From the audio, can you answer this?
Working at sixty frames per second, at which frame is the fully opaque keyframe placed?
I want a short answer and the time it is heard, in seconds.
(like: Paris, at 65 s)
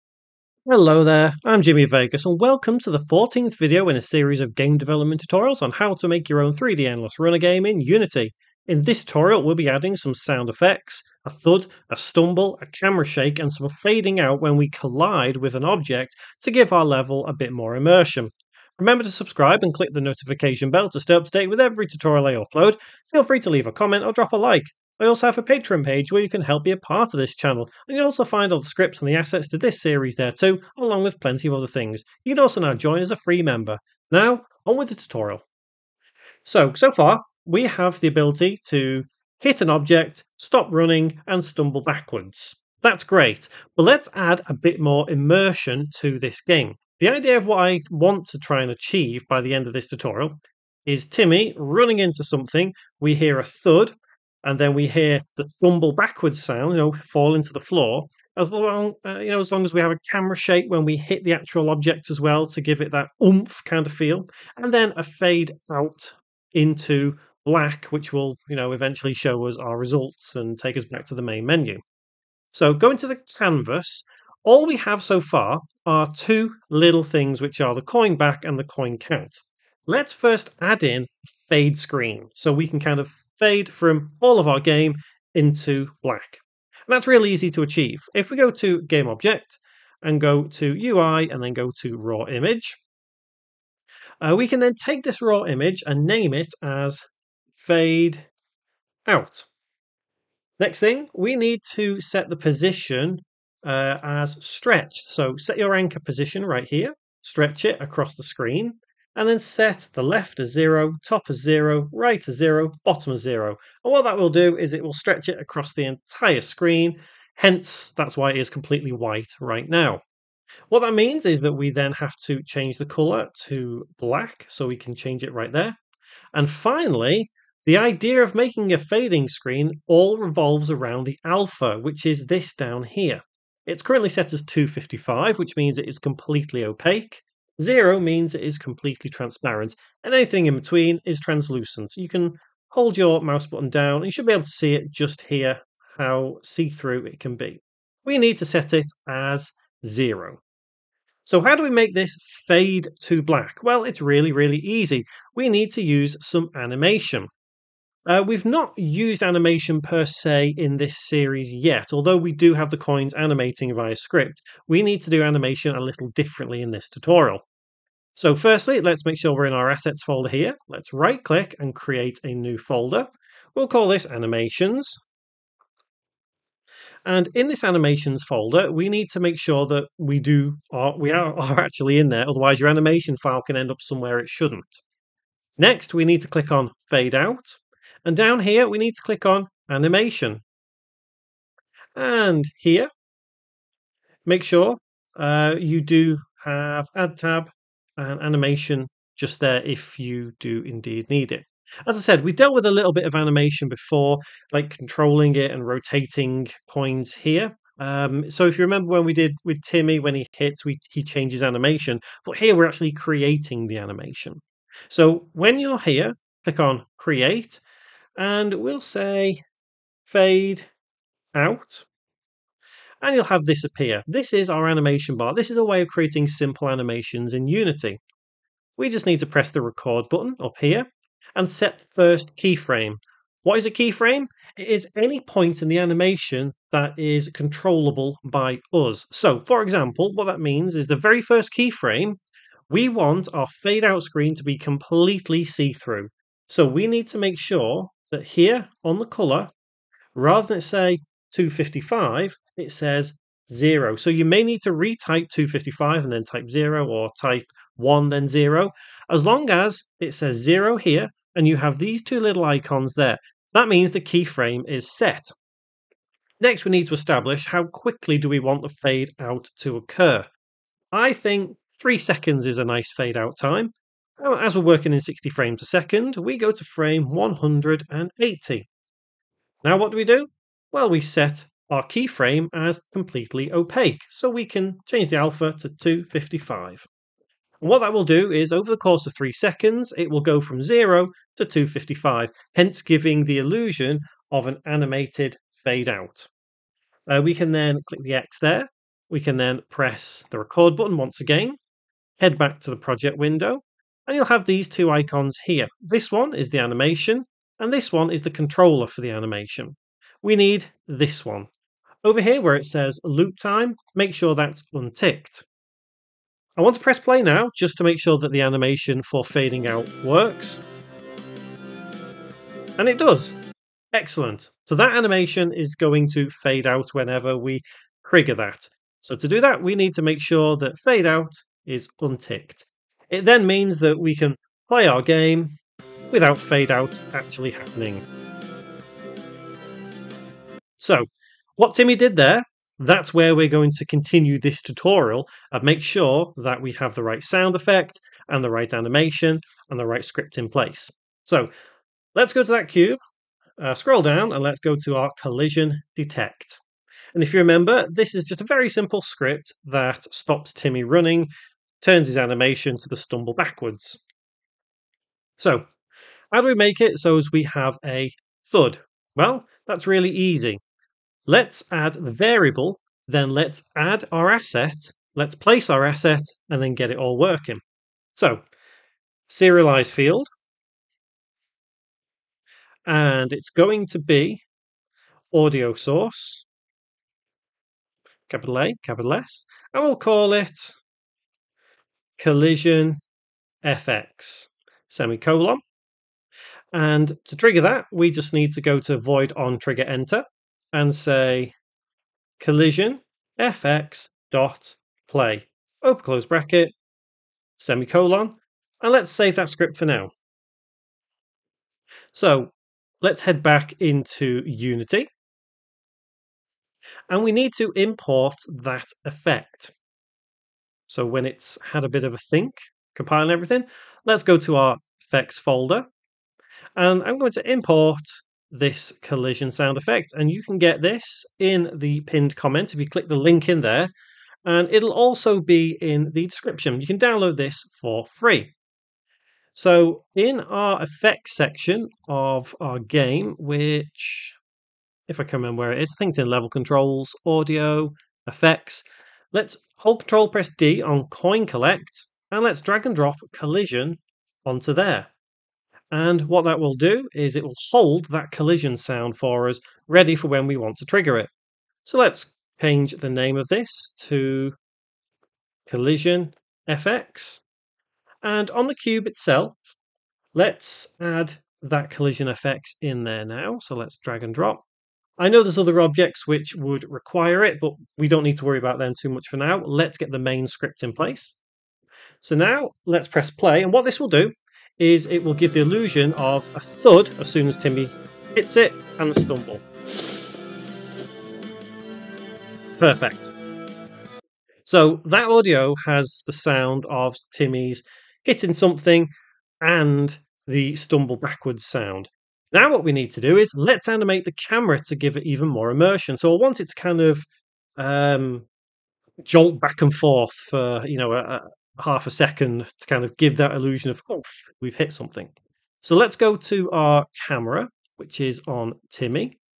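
180, at 276 s.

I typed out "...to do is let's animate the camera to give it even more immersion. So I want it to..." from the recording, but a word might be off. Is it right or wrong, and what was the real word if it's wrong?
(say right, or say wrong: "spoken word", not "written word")
right.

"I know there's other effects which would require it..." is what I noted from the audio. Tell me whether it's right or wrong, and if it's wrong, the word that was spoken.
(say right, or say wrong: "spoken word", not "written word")
wrong: "objects", not "effects".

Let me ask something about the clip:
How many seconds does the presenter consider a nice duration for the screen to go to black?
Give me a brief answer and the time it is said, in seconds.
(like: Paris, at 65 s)
3, at 271 s.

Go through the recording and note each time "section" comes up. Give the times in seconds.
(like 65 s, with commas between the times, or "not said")
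441 s.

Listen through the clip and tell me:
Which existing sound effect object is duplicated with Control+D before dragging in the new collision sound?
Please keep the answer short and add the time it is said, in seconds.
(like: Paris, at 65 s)
coin collect, at 451 s.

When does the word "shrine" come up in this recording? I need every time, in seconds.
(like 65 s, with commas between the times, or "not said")
not said.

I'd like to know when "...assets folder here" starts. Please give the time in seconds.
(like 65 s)
169 s.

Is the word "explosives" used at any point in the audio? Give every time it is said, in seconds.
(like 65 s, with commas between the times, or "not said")
not said.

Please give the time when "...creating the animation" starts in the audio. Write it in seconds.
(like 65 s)
212 s.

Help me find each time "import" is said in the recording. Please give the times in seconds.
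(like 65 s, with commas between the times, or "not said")
417 s, 427 s.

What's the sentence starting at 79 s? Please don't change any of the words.
Let's first add in fade screen so we can kind of fade from all of our game into black.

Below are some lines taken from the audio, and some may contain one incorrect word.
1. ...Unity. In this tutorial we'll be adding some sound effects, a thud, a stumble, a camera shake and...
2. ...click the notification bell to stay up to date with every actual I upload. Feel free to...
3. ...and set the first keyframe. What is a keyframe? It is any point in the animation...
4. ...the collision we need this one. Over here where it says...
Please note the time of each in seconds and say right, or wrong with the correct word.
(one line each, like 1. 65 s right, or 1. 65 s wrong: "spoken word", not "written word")
1. 7 s right
2. 19 s wrong: "tutorial", not "actual"
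3. 231 s right
4. 309 s wrong: "animation", not "collision".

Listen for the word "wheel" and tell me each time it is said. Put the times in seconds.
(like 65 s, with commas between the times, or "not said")
not said.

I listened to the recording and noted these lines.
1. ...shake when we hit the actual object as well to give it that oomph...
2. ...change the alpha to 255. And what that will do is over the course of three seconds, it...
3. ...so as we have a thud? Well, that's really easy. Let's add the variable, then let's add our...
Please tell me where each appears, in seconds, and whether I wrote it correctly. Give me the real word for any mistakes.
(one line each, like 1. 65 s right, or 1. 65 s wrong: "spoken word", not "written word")
1. 60 s right
2. 284 s right
3. 366 s right.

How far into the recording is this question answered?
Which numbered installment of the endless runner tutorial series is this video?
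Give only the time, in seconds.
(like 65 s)
2 s.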